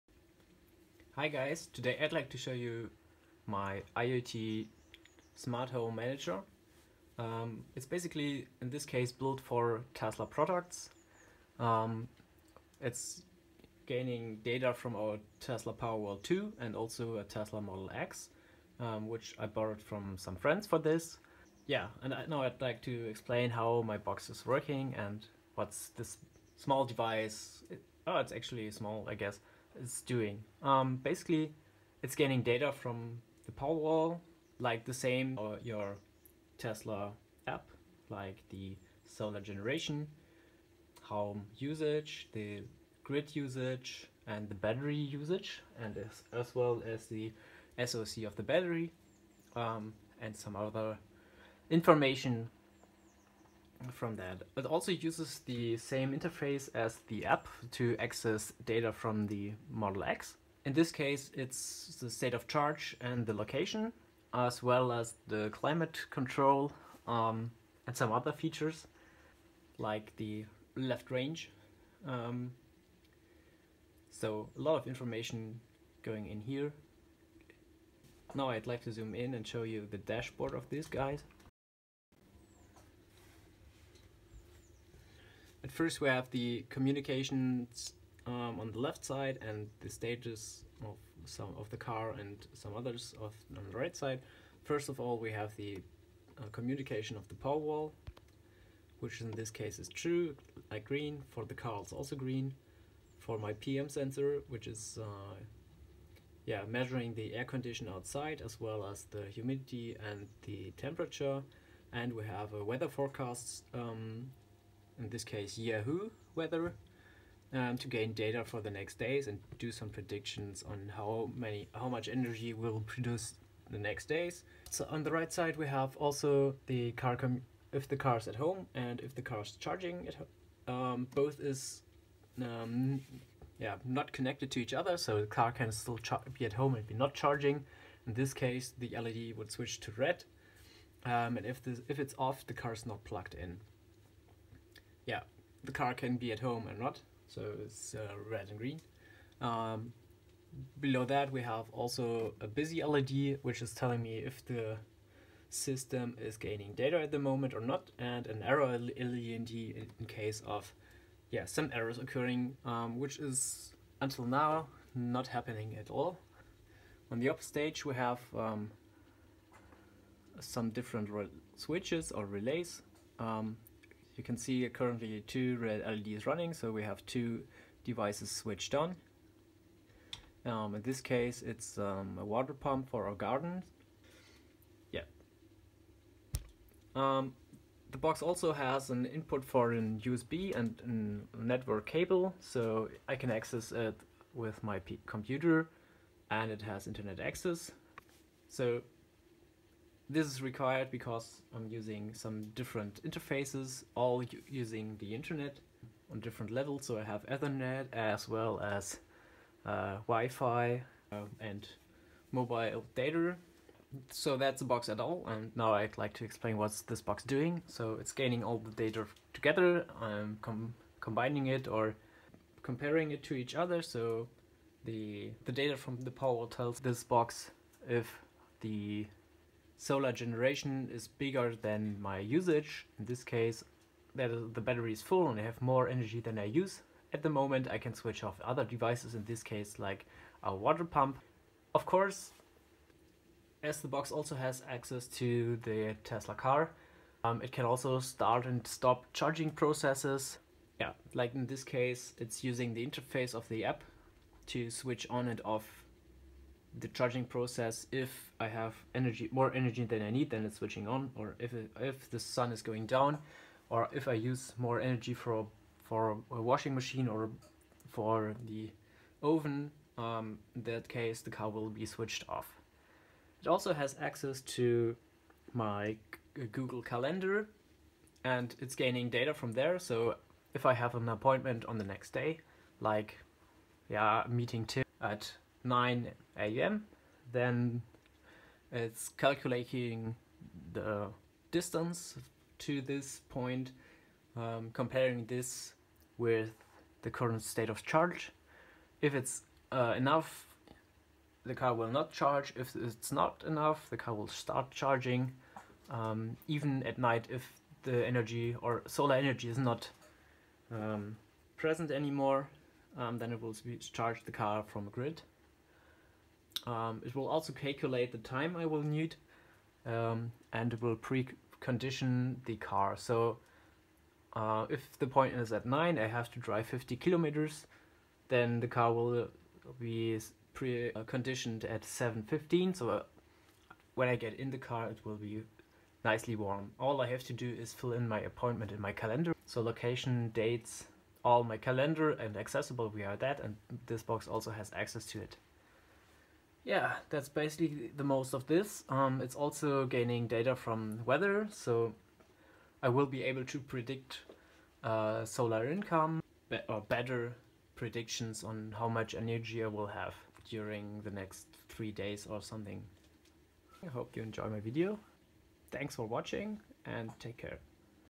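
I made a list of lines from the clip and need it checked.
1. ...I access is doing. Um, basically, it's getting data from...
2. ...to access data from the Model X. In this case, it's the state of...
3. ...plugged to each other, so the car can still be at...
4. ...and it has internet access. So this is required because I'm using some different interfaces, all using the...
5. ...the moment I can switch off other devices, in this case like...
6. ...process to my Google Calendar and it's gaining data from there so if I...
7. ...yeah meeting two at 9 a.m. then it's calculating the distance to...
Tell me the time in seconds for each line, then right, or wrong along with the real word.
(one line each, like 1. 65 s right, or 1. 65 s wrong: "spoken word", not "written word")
1. 29 s wrong: "guess", not "access"
2. 57 s right
3. 134 s wrong: "connected", not "plugged"
4. 196 s right
5. 237 s right
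6. 273 s wrong: "access", not "process"
7. 283 s right.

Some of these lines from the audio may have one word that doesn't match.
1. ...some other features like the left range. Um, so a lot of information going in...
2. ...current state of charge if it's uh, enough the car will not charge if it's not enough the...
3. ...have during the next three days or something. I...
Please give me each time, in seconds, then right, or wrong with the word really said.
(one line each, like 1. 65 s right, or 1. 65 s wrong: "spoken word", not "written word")
1. 67 s right
2. 297 s right
3. 359 s right.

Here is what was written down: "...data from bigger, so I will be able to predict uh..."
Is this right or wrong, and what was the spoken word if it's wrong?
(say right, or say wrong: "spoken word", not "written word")
wrong: "weather", not "bigger".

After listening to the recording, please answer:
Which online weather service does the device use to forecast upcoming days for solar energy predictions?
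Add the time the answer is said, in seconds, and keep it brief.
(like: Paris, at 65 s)
Yahoo weather, at 115 s.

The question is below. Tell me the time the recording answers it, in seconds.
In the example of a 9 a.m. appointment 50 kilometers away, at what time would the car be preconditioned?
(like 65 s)
331 s.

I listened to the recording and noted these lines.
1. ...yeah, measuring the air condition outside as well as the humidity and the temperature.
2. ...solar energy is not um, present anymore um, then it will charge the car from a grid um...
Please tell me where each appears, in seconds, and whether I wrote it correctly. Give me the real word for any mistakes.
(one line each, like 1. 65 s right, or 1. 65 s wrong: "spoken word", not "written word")
1. 106 s right
2. 308 s right.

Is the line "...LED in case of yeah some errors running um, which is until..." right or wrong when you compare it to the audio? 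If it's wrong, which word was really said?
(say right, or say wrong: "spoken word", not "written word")
wrong: "occurring", not "running".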